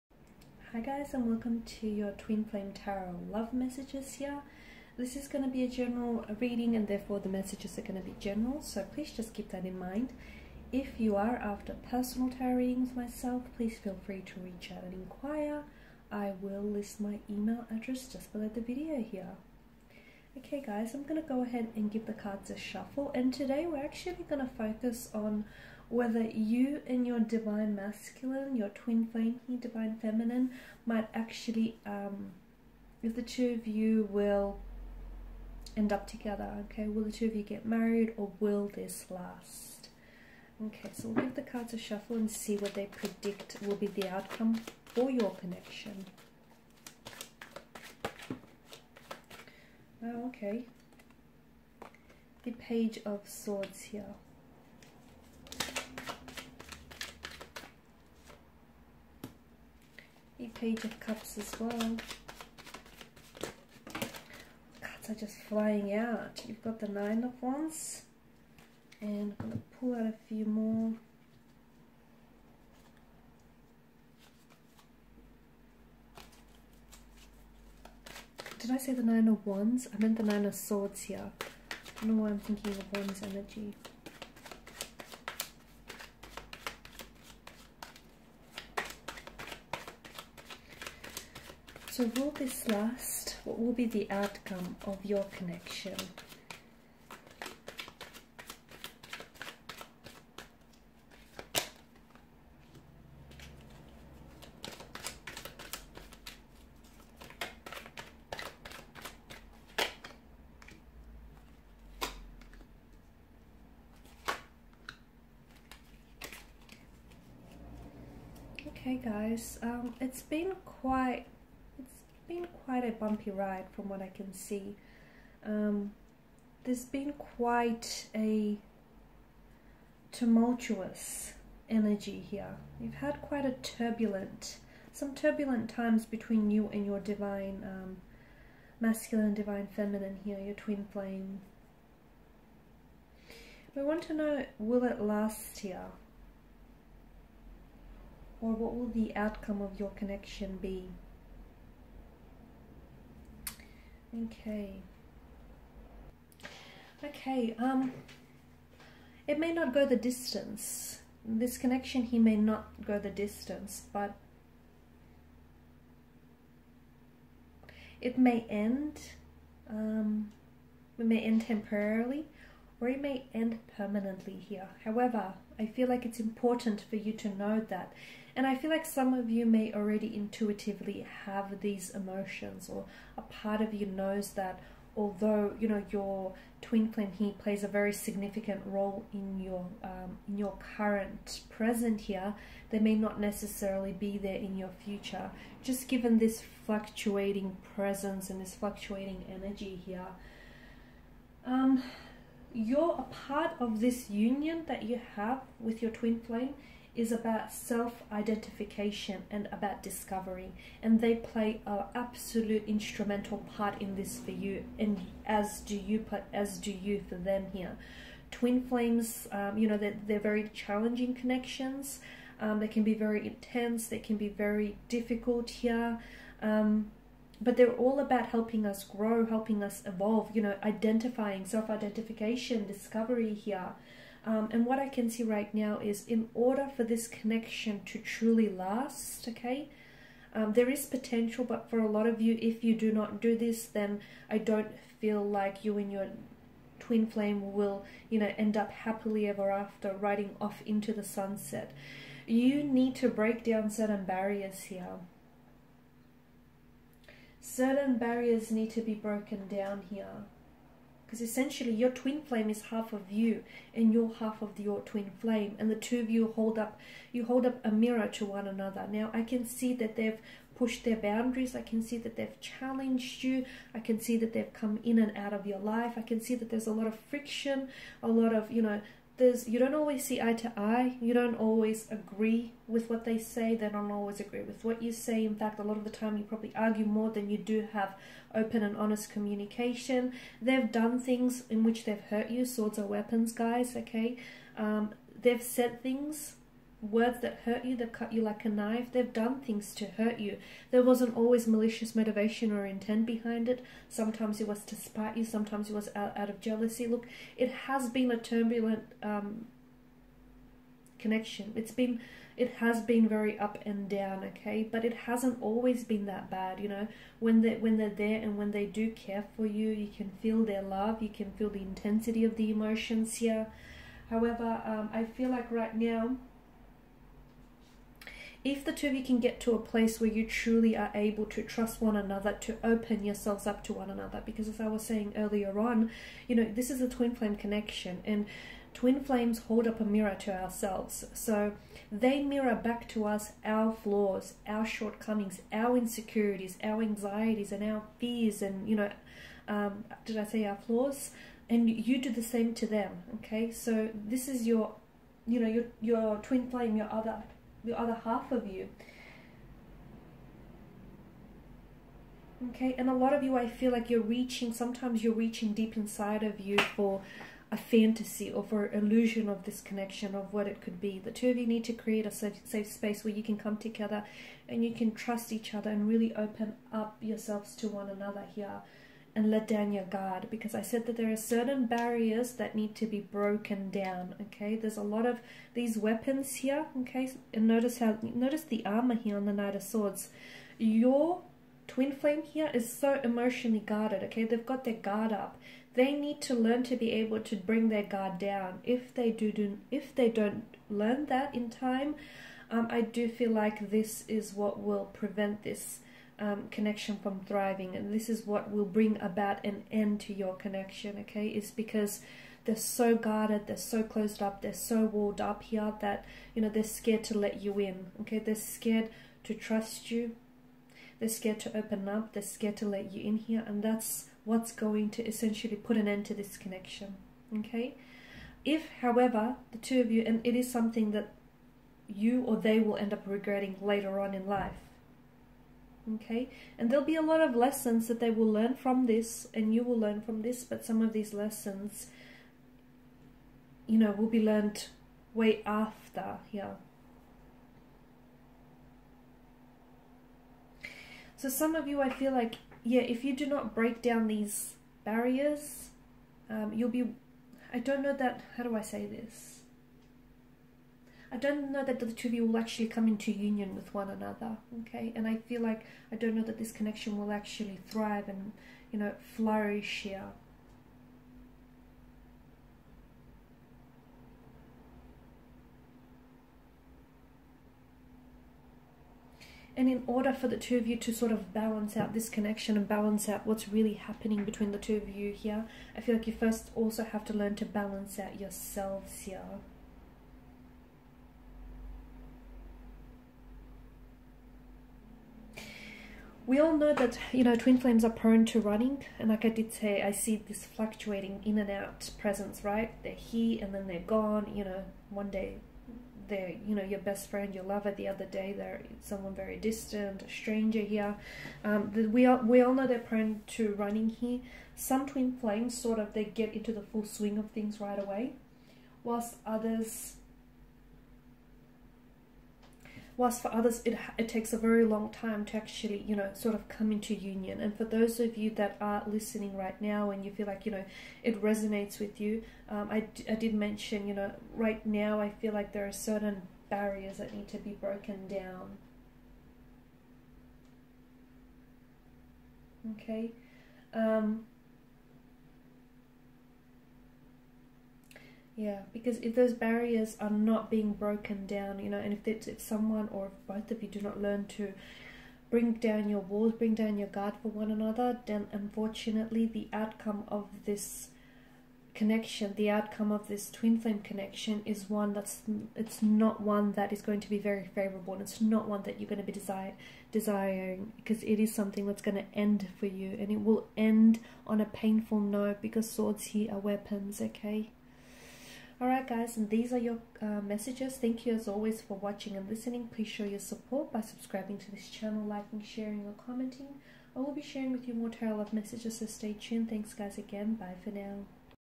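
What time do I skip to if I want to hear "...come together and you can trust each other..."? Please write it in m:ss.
6:13.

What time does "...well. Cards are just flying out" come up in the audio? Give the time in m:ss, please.
1:01.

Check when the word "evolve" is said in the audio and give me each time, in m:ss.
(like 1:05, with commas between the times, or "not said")
3:49.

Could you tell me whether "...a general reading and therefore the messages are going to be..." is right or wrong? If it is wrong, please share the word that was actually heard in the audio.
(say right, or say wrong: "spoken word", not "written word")
right.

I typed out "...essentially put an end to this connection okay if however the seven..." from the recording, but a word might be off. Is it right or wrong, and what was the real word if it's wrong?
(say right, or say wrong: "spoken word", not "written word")
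wrong: "two", not "seven".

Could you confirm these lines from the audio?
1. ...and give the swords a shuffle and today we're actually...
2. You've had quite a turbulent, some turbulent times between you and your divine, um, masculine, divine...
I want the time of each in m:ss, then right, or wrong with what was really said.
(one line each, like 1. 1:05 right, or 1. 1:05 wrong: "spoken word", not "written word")
1. 0:21 wrong: "cards", not "swords"
2. 2:12 right.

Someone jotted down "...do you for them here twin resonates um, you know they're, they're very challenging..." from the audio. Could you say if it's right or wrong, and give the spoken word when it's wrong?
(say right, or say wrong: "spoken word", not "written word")
wrong: "flames", not "resonates".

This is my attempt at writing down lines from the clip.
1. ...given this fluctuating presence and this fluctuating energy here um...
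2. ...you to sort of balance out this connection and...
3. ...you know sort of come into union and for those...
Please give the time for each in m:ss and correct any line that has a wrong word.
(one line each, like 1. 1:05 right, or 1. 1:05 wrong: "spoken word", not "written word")
1. 3:15 right
2. 8:00 right
3. 8:45 right.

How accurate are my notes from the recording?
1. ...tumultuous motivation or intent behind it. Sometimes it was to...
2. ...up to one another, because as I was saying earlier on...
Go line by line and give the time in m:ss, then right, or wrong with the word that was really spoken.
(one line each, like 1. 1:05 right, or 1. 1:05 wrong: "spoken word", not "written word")
1. 5:01 wrong: "malicious", not "tumultuous"
2. 5:33 right.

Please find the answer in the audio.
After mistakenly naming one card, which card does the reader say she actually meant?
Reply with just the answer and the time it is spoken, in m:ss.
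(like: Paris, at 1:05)
Nine of Swords, at 1:20.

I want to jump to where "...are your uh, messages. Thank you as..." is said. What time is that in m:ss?
9:39.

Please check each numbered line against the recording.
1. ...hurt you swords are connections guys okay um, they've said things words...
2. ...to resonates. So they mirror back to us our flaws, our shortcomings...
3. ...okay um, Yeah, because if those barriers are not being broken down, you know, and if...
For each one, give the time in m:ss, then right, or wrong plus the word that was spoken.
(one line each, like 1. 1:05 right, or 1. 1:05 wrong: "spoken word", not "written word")
1. 4:52 wrong: "weapons", not "connections"
2. 5:40 wrong: "ourselves", not "resonates"
3. 9:02 right.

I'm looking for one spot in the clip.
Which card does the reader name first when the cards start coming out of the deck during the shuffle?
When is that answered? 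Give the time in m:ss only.
0:52.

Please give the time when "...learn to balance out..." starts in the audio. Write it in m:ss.
8:07.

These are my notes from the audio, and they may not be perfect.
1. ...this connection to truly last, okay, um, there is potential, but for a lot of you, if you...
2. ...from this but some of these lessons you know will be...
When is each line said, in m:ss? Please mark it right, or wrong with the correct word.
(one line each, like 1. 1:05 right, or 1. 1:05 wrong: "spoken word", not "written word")
1. 3:56 right
2. 7:20 right.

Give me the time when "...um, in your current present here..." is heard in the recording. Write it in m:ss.
3:09.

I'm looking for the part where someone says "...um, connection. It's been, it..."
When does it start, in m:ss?
5:09.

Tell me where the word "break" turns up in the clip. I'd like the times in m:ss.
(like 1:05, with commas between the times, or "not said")
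4:13, 7:33.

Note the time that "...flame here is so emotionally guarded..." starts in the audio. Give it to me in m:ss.
6:31.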